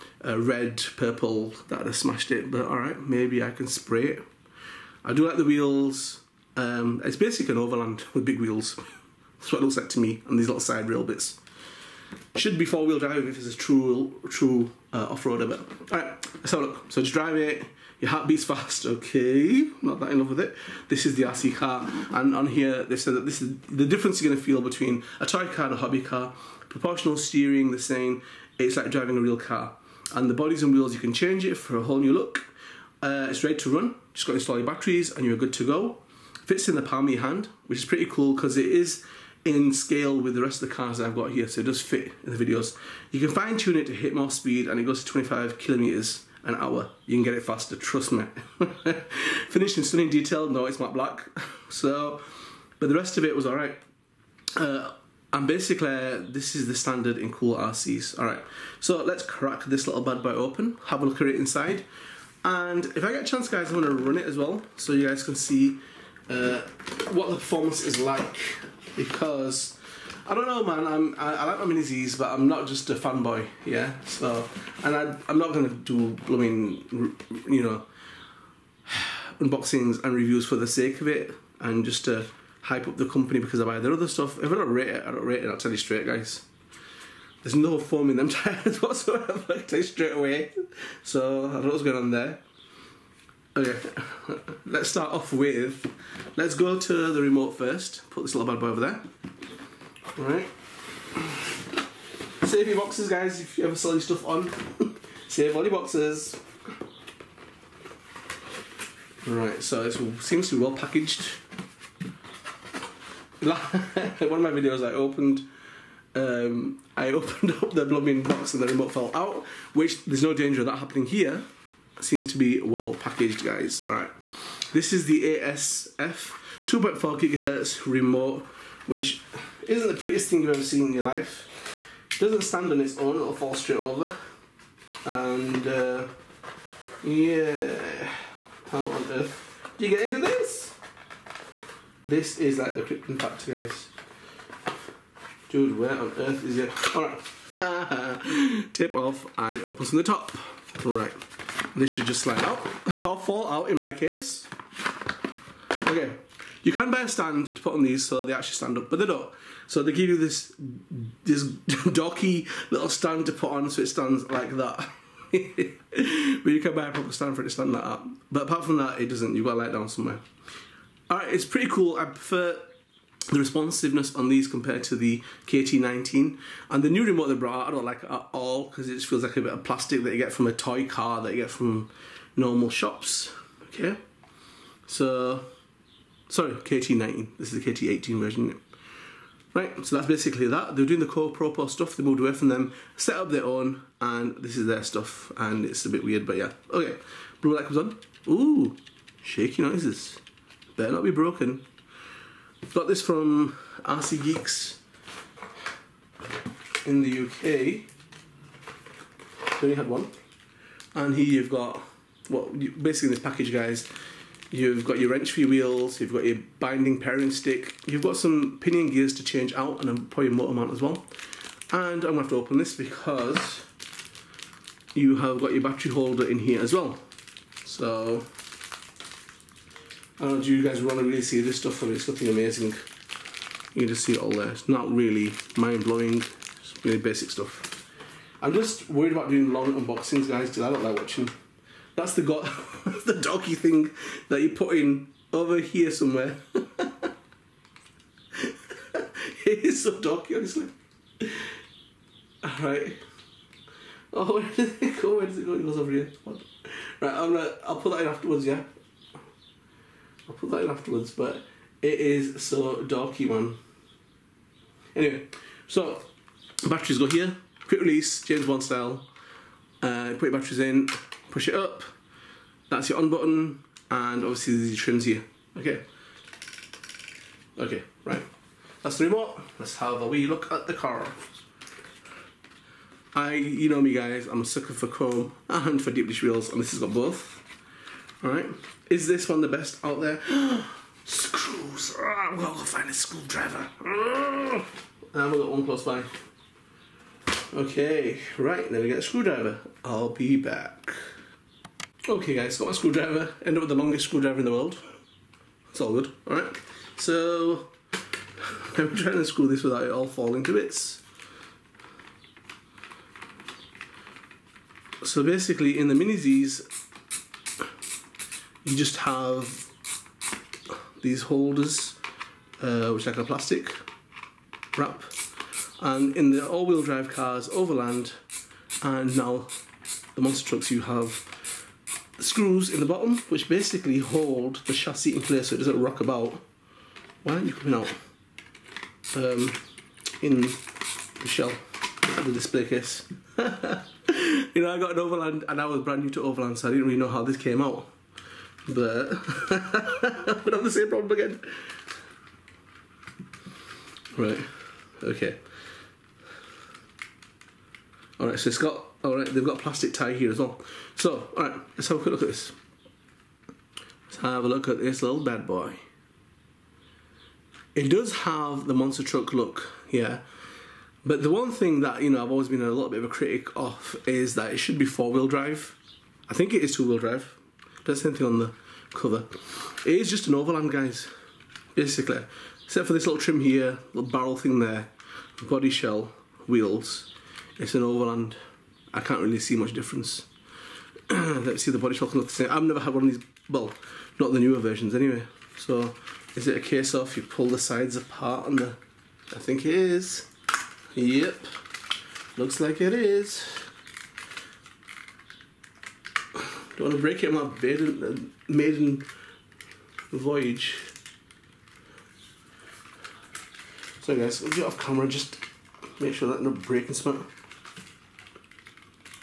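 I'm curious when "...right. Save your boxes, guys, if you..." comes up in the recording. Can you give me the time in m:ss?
1:40.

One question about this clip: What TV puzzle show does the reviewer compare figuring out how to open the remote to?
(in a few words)
Krypton Factor.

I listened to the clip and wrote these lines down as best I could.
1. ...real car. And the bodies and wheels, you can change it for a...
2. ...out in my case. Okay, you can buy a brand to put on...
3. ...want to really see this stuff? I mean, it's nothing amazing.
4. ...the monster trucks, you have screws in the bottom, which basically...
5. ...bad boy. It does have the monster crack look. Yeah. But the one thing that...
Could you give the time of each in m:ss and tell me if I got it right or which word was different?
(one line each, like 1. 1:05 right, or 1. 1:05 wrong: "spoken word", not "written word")
1. 0:29 right
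2. 2:33 wrong: "stand", not "brand"
3. 3:50 right
4. 5:30 right
5. 6:05 wrong: "truck", not "crack".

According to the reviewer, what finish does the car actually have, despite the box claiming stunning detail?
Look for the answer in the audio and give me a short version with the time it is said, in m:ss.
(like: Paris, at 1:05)
matte black, at 0:50.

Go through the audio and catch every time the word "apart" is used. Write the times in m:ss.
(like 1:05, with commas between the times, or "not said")
2:48, 6:37.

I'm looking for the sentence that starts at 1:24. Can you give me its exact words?
If I don't rate it, I don't rate it.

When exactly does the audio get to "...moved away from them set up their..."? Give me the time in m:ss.
3:12.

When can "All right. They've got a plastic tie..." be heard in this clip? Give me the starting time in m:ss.
5:59.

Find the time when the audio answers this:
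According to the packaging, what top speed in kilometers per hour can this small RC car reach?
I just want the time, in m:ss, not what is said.
0:45.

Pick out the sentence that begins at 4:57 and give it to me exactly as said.
Okay, right, Now we get a screwdriver.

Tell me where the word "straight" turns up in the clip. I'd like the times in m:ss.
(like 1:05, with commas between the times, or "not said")
1:25, 1:29, 2:13.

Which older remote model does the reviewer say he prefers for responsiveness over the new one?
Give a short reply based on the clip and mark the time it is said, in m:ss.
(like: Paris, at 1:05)
KT18, at 3:07.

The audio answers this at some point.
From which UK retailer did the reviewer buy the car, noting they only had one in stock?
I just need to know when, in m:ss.
3:23.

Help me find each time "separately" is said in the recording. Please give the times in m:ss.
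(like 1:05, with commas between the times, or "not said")
not said.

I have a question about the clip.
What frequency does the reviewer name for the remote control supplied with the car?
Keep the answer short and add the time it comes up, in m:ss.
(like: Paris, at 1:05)
2.4 gigahertz, at 2:06.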